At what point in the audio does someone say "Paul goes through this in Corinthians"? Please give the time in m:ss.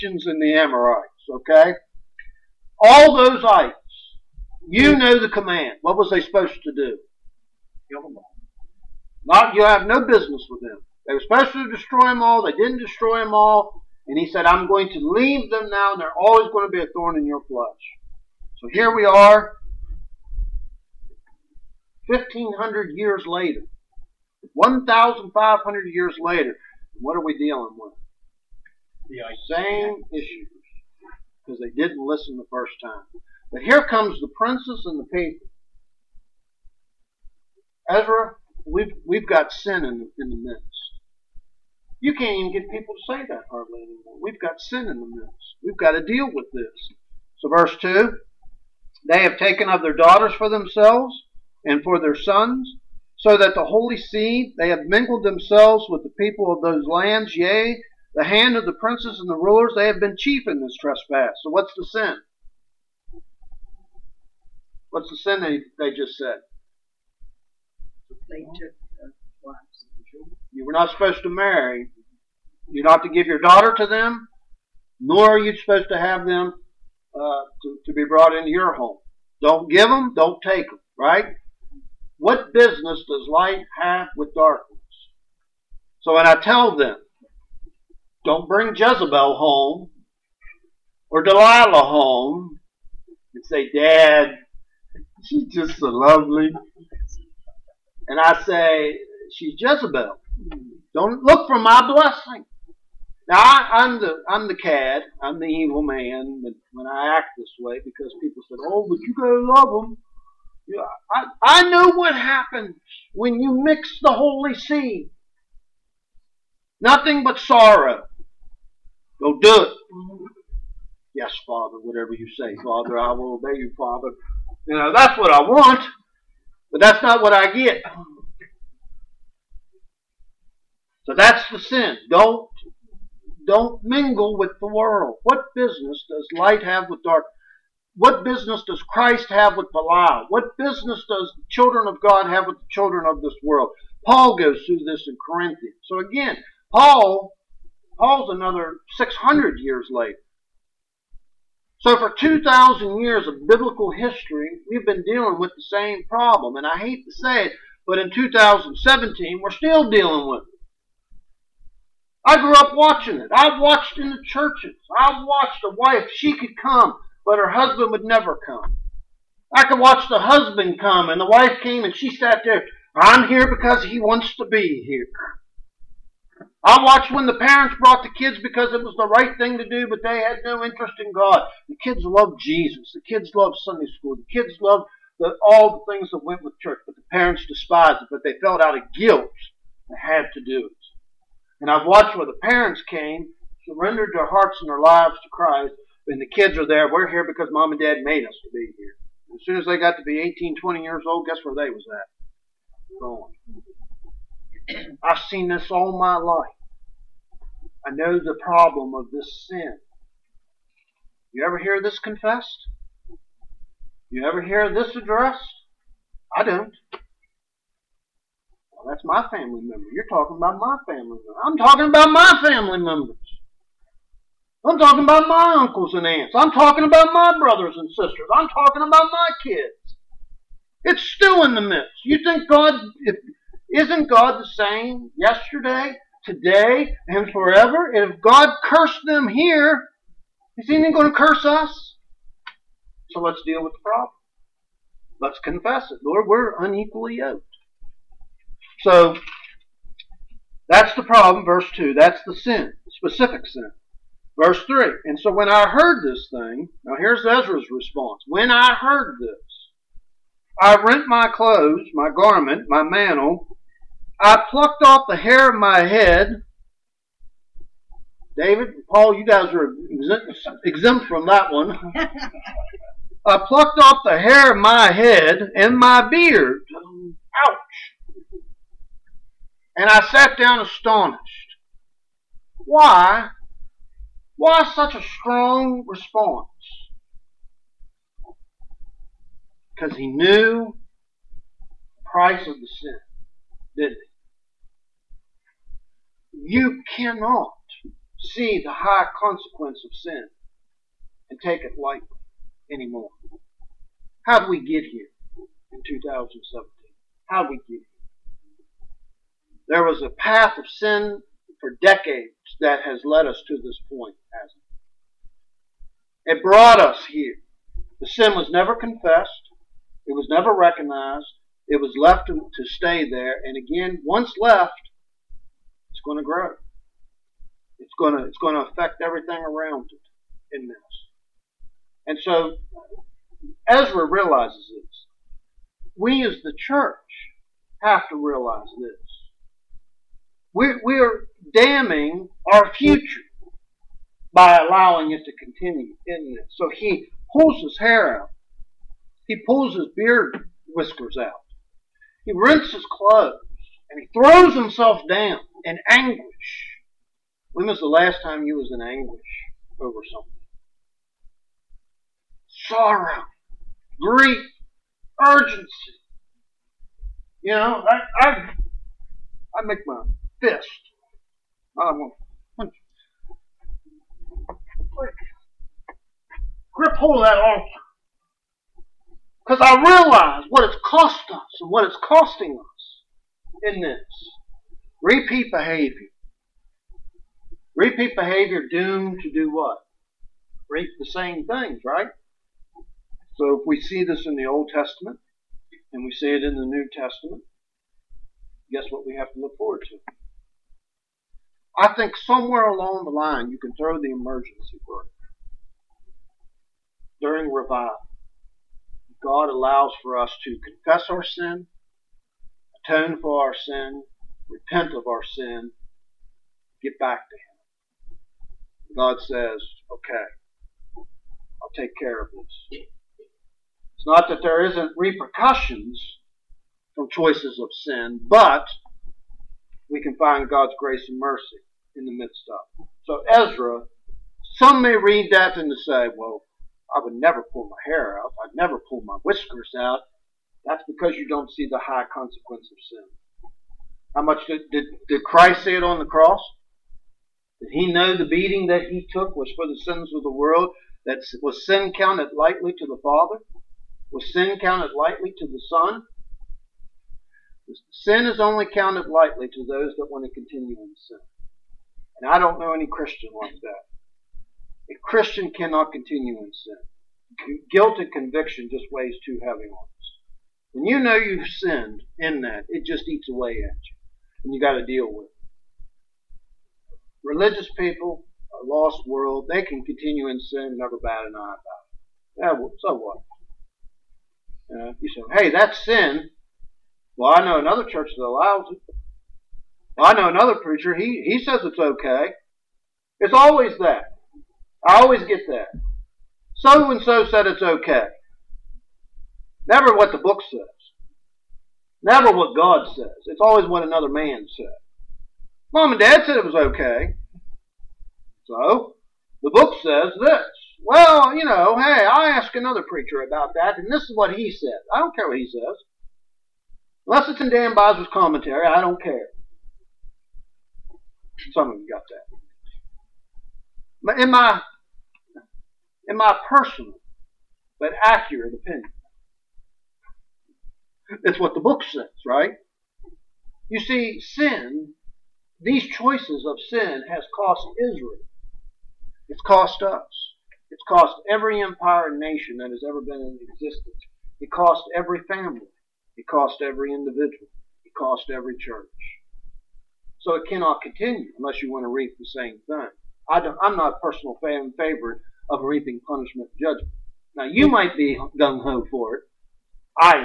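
2:24.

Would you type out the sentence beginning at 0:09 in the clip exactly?
Not, you have no business with them.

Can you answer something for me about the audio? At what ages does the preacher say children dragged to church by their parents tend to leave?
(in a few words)
18, 20.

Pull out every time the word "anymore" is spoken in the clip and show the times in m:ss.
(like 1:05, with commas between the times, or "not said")
0:43, 5:02.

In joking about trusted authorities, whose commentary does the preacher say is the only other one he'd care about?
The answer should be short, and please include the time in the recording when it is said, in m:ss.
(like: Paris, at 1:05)
Dan Bosworth, at 8:37.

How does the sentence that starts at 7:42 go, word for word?
And I don't know any Christian like that.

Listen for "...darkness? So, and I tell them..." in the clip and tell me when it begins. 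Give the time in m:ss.
1:24.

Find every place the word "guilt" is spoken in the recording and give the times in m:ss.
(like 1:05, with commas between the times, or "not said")
3:08, 7:47.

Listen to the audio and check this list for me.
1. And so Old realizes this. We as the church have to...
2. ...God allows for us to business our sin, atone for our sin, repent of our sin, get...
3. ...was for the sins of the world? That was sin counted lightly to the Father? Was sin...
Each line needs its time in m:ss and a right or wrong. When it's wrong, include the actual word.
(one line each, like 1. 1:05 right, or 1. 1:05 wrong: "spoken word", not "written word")
1. 5:32 wrong: "Ezra", not "Old"
2. 6:49 wrong: "confess", not "business"
3. 7:29 right.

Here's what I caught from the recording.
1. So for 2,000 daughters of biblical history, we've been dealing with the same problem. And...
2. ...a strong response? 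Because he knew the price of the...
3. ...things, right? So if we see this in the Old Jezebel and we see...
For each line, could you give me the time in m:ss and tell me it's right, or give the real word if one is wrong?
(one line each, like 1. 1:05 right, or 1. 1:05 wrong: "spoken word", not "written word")
1. 2:31 wrong: "years", not "daughters"
2. 4:44 right
3. 6:31 wrong: "Testament", not "Jezebel".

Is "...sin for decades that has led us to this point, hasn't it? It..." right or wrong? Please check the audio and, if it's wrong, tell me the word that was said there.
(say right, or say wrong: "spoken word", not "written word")
right.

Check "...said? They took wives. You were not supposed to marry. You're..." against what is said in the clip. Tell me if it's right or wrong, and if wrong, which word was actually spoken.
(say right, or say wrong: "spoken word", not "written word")
right.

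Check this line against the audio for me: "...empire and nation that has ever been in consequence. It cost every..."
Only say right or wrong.
wrong.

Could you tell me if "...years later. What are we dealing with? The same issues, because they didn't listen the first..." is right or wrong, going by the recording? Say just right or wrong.
right.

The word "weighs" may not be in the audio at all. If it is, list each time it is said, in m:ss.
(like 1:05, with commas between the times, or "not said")
7:48.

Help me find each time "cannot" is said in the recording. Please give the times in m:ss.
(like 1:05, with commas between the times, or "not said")
4:56, 7:45, 9:10.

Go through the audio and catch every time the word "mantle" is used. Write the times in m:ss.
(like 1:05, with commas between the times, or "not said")
4:22.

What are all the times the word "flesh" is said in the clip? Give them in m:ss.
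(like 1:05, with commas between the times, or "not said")
0:17.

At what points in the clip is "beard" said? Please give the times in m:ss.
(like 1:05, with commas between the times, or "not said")
4:36, 5:49.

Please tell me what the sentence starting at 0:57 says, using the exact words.
Yea, the hand of the princes and the rulers, they have been chief in this trespass.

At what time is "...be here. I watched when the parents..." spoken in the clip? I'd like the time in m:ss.
2:54.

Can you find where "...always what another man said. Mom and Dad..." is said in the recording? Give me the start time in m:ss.
8:23.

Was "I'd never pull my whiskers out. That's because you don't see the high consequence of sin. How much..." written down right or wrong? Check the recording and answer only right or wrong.
right.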